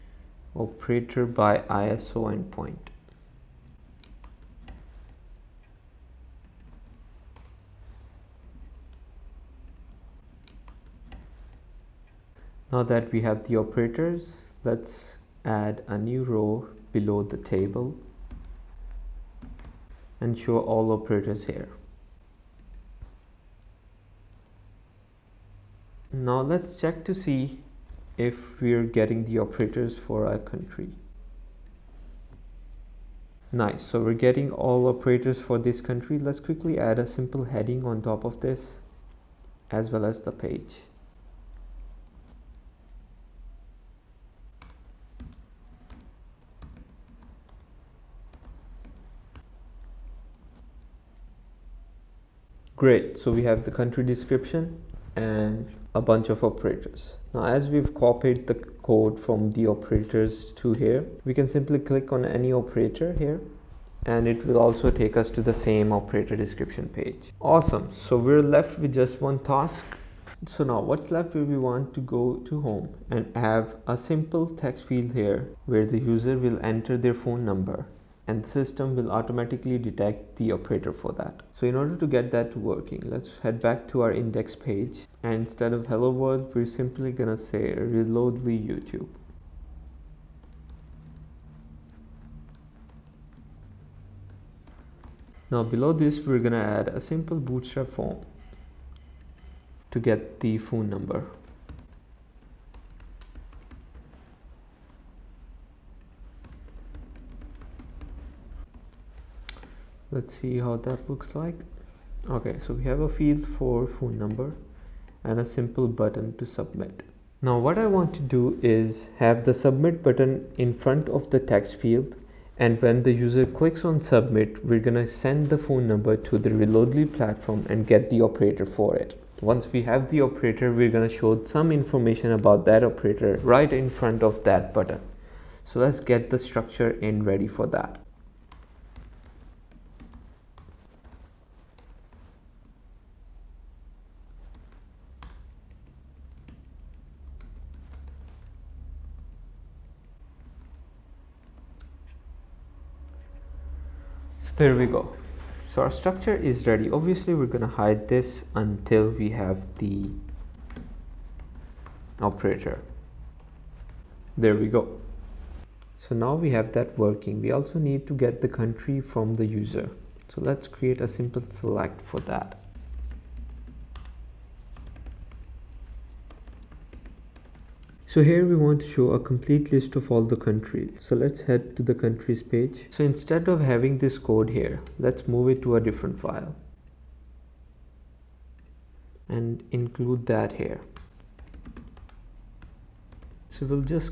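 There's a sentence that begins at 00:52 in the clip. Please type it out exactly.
Great, so we have the country description and a bunch of operators.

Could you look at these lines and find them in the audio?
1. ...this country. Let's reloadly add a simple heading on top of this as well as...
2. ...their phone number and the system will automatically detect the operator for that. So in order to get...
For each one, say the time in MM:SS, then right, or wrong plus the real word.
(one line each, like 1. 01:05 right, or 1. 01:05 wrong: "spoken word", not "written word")
1. 00:35 wrong: "quickly", not "reloadly"
2. 01:16 right.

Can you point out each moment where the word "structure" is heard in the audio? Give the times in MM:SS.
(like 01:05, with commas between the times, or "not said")
02:16, 02:35.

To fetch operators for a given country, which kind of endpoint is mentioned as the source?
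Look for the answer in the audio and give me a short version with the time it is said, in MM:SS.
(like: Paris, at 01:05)
ISO endpoint, at 00:01.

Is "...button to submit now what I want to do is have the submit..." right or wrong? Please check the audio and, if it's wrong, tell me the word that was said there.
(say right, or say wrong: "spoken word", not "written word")
right.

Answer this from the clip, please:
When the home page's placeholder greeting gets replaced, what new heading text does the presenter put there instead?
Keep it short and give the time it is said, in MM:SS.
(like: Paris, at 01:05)
reloadly YouTube, at 01:27.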